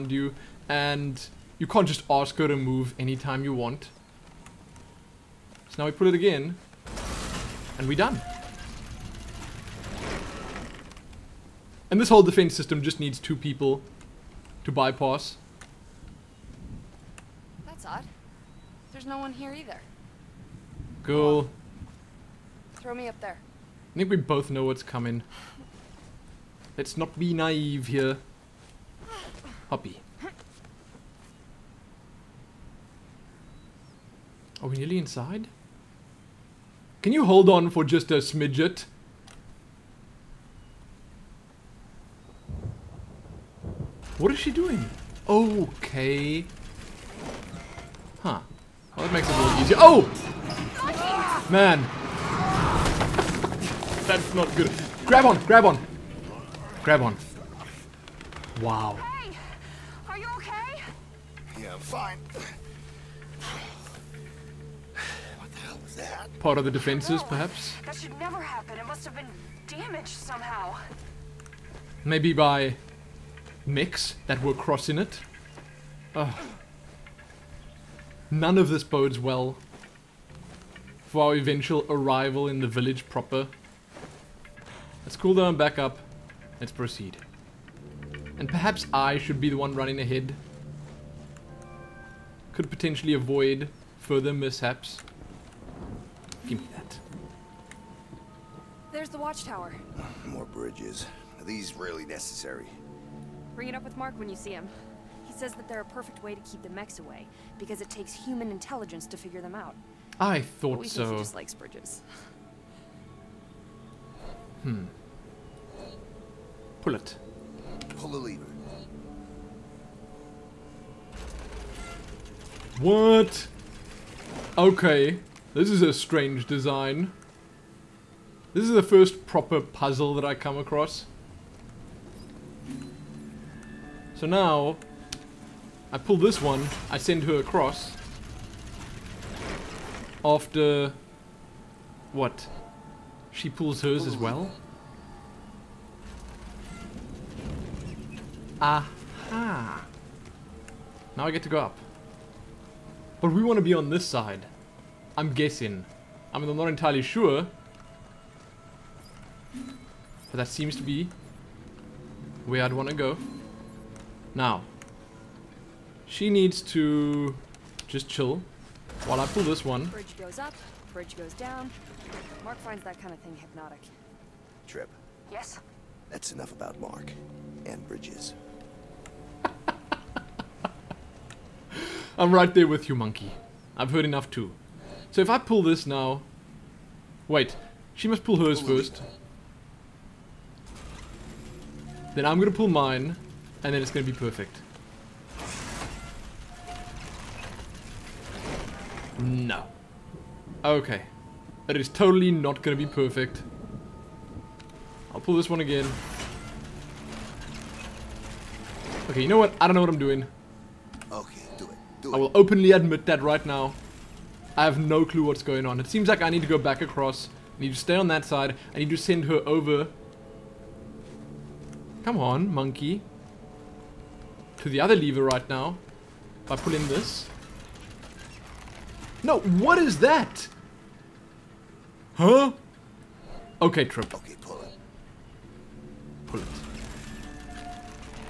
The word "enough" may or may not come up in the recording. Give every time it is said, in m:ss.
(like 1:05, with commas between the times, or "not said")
2:56, 3:04.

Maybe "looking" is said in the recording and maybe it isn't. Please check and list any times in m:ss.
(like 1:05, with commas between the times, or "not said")
not said.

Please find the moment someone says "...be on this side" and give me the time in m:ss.
2:33.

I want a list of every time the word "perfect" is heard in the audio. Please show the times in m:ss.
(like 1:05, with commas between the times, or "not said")
1:45, 3:14, 3:22.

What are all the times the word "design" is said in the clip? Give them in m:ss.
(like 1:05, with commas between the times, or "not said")
2:06.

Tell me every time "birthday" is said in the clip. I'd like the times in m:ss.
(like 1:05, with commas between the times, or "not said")
not said.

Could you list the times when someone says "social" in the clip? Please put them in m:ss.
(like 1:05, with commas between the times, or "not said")
not said.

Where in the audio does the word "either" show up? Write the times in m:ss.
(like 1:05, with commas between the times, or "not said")
0:19.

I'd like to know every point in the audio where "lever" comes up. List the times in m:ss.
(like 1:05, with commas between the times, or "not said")
1:58, 3:44.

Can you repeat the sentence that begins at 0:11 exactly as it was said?
And this whole defense system just needs two people to bypass.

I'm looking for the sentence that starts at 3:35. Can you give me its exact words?
It seems like I need to go back across.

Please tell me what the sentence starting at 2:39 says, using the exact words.
But that seems to be where I'd want to go.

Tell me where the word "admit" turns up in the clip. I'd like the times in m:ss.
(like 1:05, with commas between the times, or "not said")
3:32.